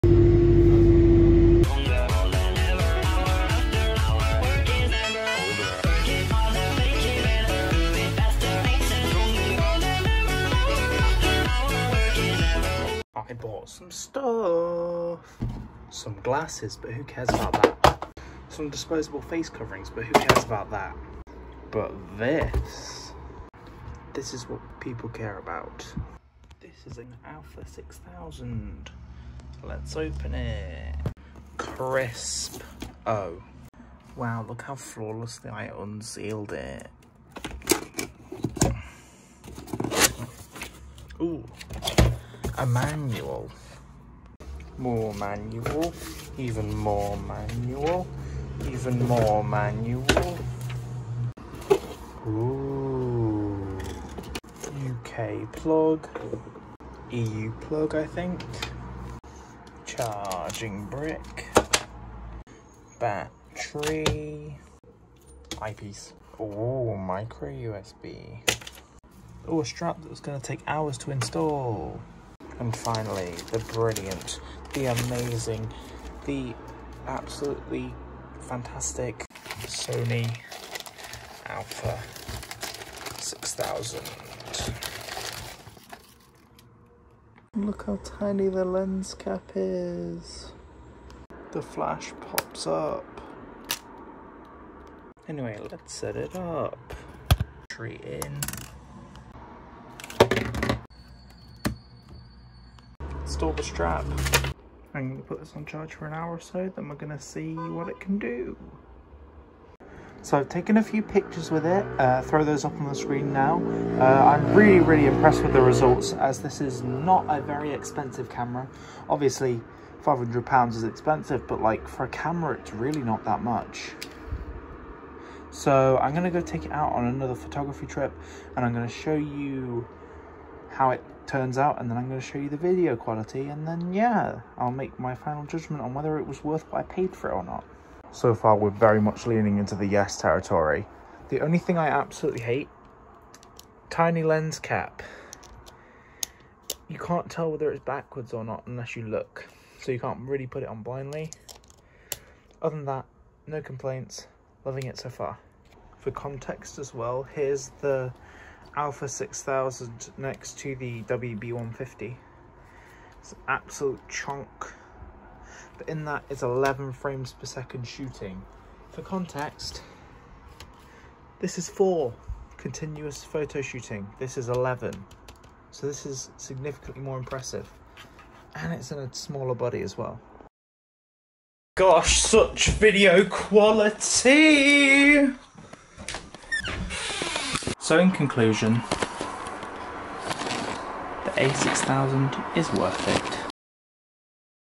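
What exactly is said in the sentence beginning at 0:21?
But this, this is what people care about.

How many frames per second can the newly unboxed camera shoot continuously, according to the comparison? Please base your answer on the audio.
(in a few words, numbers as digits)
11.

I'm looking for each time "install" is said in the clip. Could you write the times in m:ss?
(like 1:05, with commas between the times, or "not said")
1:11, 1:43.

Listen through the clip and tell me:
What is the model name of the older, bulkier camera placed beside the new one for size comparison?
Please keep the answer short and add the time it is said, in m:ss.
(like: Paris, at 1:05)
WB150, at 2:41.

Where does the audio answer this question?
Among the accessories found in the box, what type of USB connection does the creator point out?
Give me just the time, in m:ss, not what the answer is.
1:06.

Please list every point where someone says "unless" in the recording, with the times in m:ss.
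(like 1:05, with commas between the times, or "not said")
2:28.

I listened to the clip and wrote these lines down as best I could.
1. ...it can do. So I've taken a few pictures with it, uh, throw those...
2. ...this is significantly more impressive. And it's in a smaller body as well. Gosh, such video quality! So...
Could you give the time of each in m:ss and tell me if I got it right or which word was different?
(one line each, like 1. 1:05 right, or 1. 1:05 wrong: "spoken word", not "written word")
1. 1:47 right
2. 2:55 right.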